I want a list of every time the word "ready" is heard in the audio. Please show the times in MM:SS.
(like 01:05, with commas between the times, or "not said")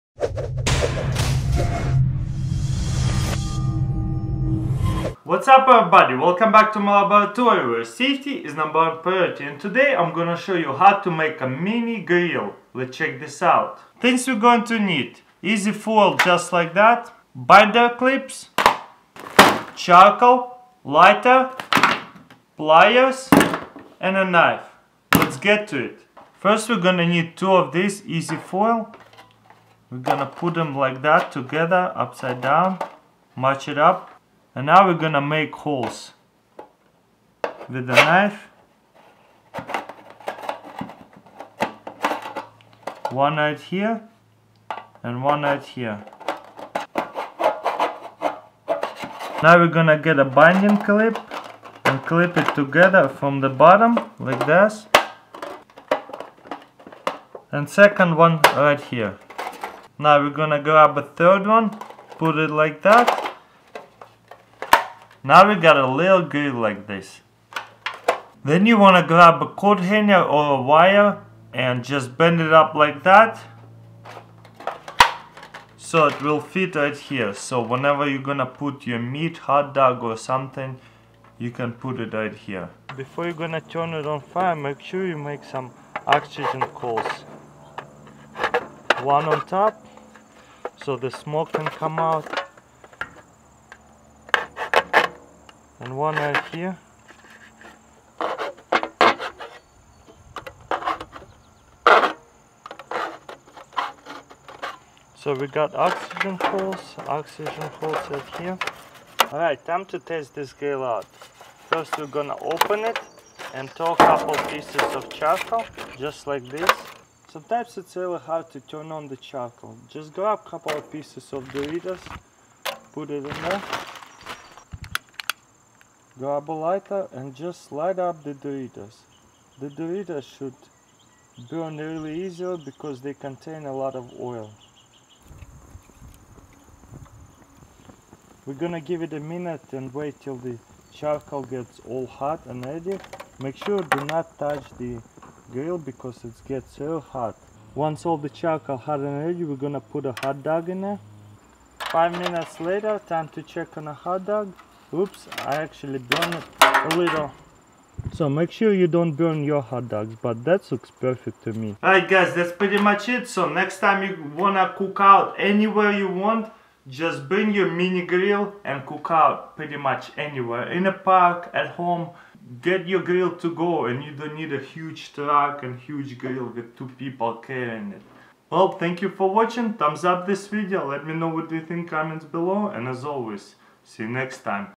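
02:22, 02:29.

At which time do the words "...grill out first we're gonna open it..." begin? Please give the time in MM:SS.
01:50.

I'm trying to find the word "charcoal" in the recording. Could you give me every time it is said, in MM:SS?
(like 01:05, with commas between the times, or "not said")
00:19, 01:55, 01:59, 02:20, 02:28.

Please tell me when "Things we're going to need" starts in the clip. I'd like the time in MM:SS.
00:13.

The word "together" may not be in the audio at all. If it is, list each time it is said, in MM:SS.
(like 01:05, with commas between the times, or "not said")
00:31, 00:52.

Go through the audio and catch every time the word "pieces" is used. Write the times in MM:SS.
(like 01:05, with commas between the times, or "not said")
01:54, 02:00.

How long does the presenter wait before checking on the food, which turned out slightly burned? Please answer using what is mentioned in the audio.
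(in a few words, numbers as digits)
5 minutes.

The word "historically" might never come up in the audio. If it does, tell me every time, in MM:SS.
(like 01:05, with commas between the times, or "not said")
not said.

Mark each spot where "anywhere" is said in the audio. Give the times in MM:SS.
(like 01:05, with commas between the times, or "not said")
02:45, 02:50.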